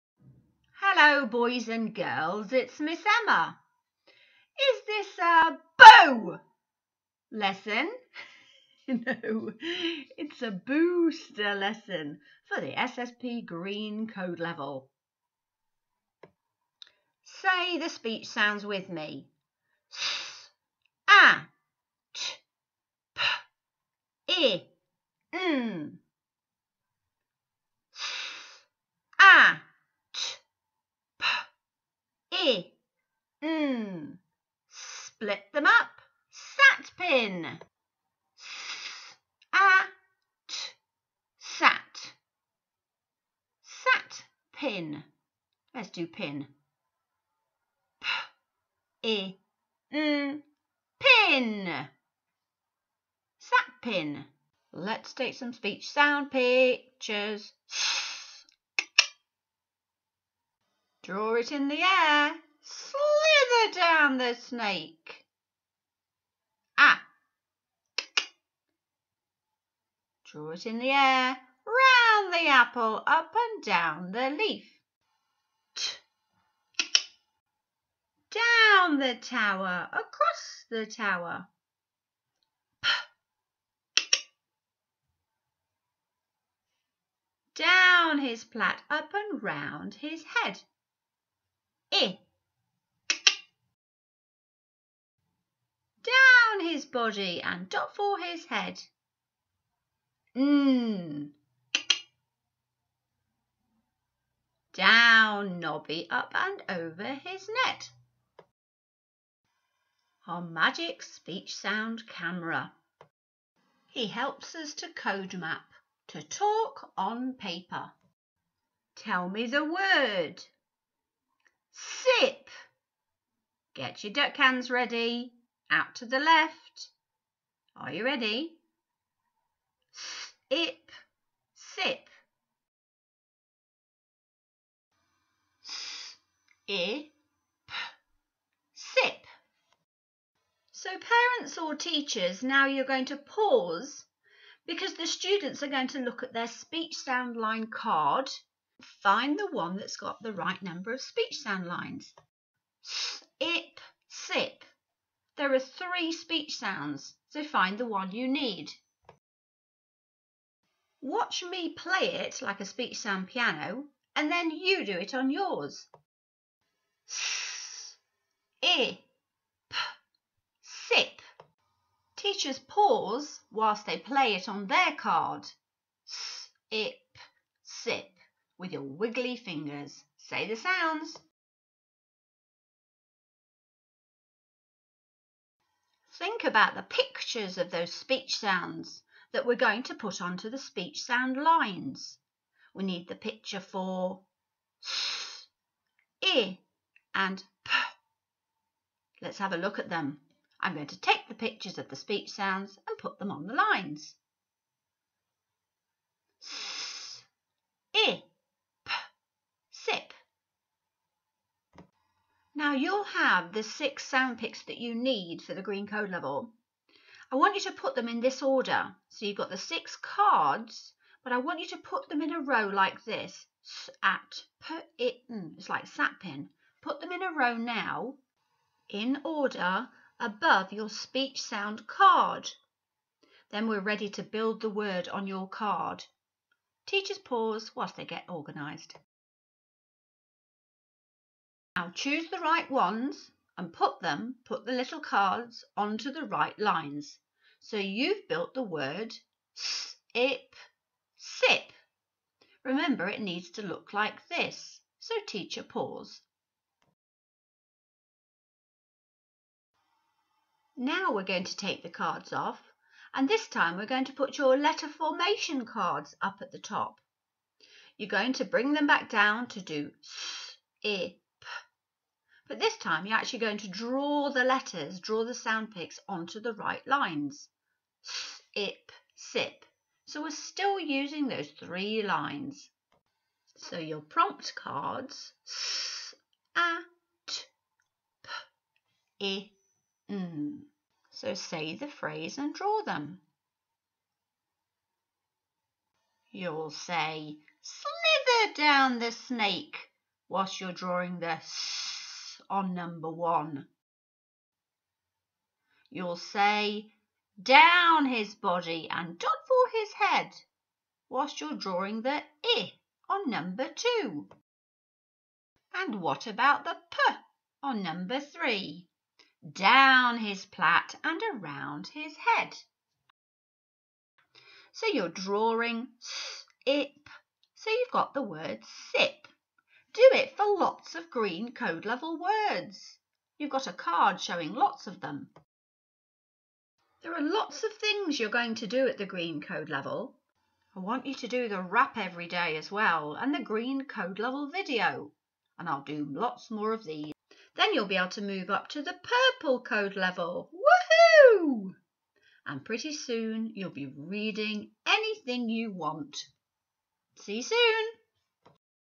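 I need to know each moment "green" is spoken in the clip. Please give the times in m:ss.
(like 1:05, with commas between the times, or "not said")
0:13, 3:35, 5:31, 5:39, 5:43.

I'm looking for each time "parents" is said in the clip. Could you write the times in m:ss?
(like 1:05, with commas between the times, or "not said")
2:20.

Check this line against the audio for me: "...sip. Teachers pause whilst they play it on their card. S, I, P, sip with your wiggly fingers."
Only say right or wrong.
right.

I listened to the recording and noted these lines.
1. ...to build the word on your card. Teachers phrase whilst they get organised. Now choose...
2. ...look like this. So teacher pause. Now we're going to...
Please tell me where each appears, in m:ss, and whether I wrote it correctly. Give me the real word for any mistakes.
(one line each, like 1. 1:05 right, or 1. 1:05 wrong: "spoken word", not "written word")
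1. 3:54 wrong: "pause", not "phrase"
2. 4:13 right.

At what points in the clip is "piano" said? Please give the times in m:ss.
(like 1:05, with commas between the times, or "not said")
2:43.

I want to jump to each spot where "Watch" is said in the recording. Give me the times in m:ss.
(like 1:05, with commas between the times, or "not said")
2:41.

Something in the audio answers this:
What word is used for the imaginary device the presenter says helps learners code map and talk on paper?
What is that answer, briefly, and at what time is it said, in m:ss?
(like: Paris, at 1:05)
magic speech sound camera, at 1:50.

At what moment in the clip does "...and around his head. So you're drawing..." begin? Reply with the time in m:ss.
5:21.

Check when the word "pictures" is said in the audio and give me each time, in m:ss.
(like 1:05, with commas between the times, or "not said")
0:56, 3:06, 3:13, 3:21.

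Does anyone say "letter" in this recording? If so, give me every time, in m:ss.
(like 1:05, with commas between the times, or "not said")
4:24, 4:34.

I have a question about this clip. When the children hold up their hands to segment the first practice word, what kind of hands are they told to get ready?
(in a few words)
duck hands.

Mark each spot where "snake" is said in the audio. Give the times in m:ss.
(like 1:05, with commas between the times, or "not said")
1:04, 4:59.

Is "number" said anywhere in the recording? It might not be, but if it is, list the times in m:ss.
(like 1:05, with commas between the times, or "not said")
2:30, 5:02, 5:13, 5:17.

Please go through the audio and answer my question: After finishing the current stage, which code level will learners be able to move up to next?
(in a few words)
purple code level.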